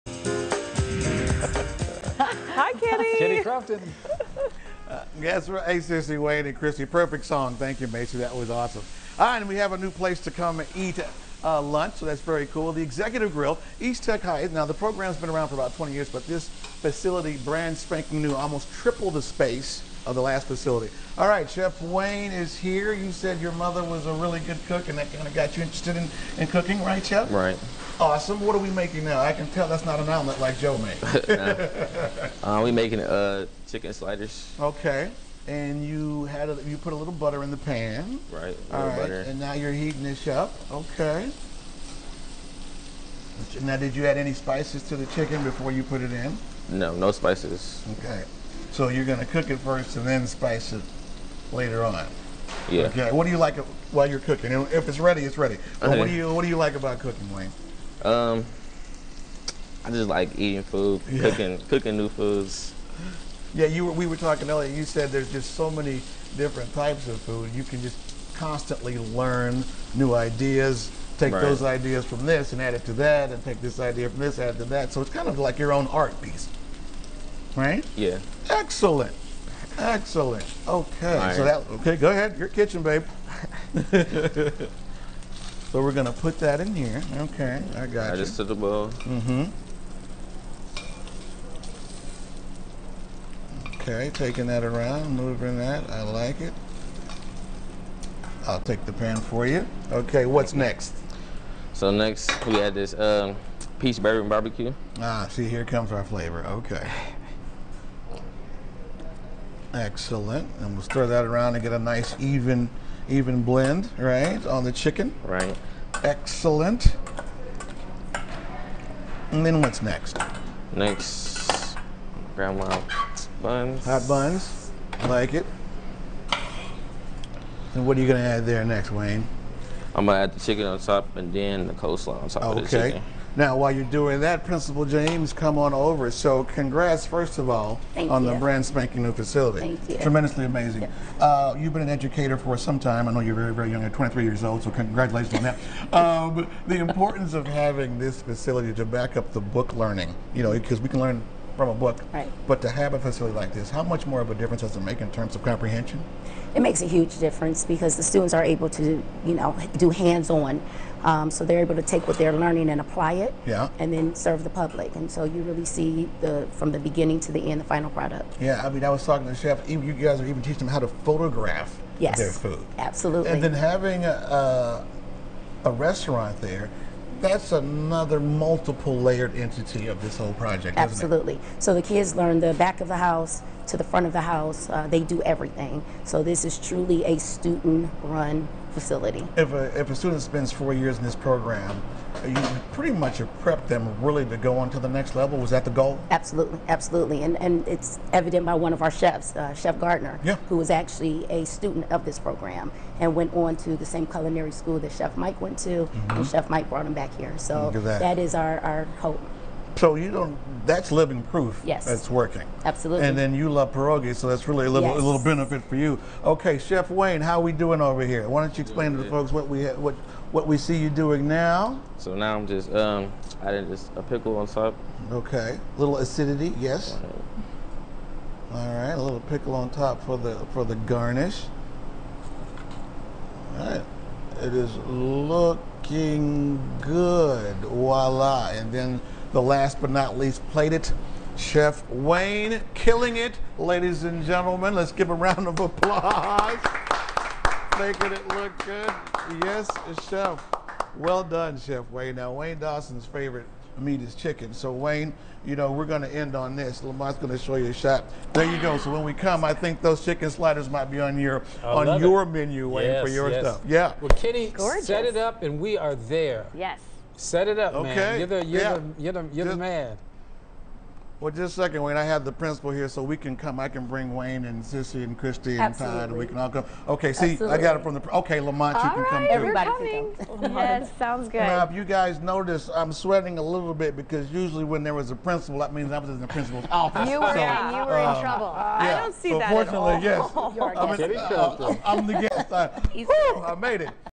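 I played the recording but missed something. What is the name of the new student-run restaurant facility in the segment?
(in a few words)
The Executive Grille.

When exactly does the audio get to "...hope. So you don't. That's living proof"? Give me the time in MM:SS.
03:29.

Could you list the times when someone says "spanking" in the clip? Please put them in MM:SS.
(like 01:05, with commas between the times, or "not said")
00:17, 02:18.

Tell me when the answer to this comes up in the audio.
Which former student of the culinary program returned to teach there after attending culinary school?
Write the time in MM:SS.
03:19.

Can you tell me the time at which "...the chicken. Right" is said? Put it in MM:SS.
01:54.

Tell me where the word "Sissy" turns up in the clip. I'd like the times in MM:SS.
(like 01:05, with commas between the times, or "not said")
00:05, 04:34.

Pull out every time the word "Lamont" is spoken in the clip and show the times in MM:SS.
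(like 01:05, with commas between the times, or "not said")
04:16, 04:38.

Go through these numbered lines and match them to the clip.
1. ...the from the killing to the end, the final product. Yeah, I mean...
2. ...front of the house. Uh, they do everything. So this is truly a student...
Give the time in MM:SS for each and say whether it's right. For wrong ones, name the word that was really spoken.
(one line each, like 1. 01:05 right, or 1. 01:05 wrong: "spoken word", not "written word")
1. 02:46 wrong: "beginning", not "killing"
2. 03:03 right.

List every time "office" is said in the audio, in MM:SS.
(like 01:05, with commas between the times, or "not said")
04:46.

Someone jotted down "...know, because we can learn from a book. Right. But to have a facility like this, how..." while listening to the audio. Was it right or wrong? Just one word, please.
right.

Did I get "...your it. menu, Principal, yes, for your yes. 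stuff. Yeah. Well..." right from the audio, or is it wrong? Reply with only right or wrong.
wrong.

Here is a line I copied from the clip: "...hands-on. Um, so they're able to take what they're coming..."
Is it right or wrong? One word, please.
wrong.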